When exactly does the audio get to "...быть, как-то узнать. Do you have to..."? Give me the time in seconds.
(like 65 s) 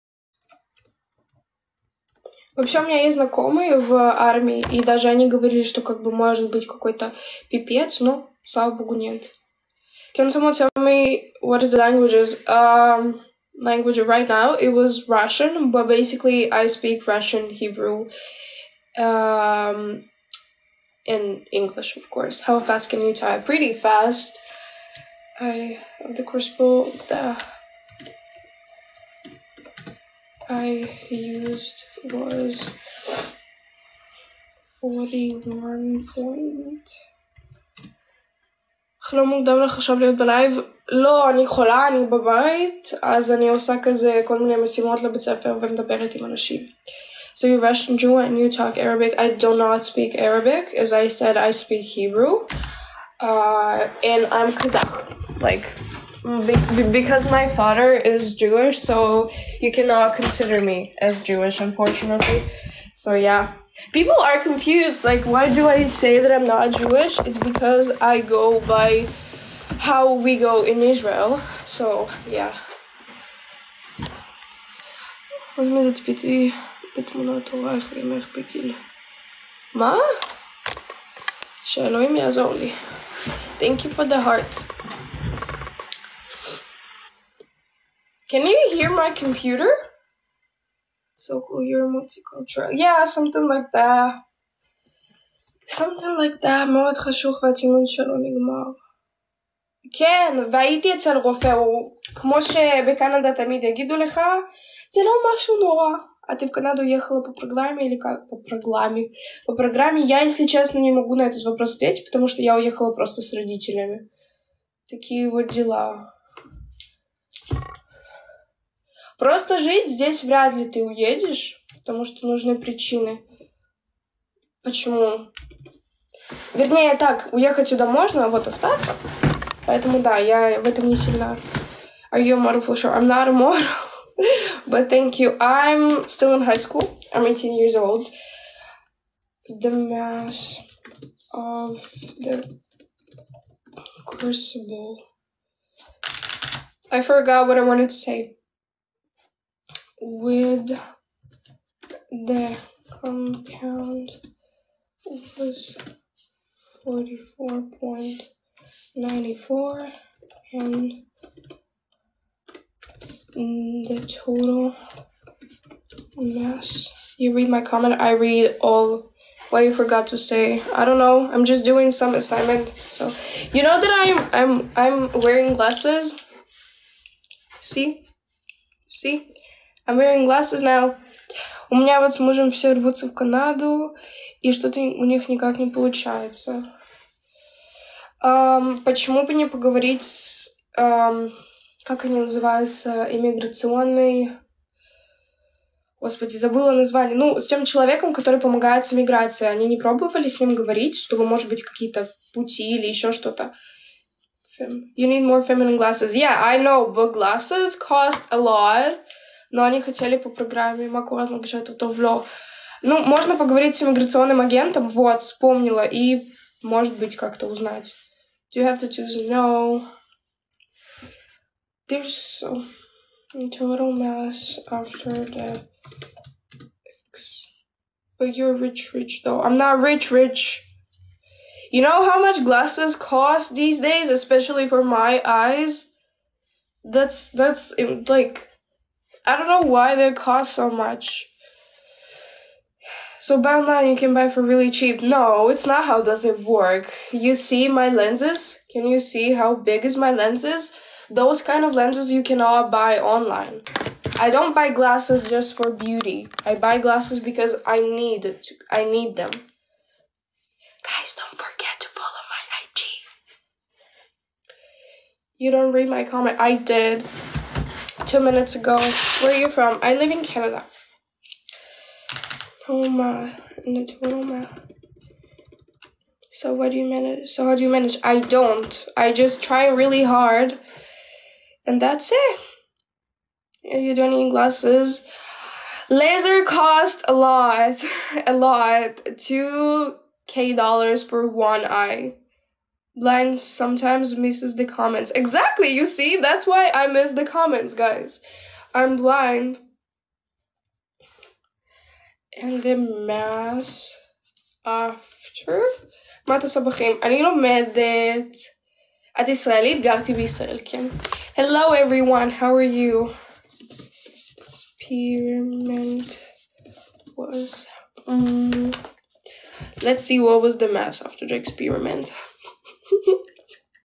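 216 s.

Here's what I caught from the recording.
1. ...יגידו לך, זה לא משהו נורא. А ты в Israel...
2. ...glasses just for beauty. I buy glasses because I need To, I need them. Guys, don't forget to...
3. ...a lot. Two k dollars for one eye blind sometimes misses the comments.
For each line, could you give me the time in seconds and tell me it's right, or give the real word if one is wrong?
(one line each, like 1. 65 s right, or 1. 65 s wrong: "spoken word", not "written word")
1. 103 s wrong: "Канаду", not "Israel"
2. 254 s right
3. 288 s right.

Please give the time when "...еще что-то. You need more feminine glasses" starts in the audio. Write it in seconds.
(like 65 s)
202 s.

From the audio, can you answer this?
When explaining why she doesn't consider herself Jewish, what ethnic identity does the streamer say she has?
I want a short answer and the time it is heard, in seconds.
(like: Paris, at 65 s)
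Kazakh, at 54 s.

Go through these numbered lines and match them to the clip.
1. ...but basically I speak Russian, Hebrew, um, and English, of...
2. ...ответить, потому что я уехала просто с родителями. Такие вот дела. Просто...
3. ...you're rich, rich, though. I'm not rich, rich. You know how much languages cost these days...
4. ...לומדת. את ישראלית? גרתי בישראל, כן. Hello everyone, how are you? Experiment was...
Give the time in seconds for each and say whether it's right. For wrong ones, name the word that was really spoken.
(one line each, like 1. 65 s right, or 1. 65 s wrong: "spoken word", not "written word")
1. 15 s right
2. 111 s right
3. 228 s wrong: "glasses", not "languages"
4. 307 s right.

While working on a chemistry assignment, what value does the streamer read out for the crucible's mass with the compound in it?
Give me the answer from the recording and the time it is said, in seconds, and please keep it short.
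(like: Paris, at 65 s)
44.94, at 156 s.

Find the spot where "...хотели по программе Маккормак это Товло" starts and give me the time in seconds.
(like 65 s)
209 s.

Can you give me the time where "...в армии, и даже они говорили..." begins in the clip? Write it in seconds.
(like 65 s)
3 s.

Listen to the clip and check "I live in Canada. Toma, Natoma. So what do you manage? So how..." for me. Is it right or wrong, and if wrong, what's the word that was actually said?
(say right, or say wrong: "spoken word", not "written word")
right.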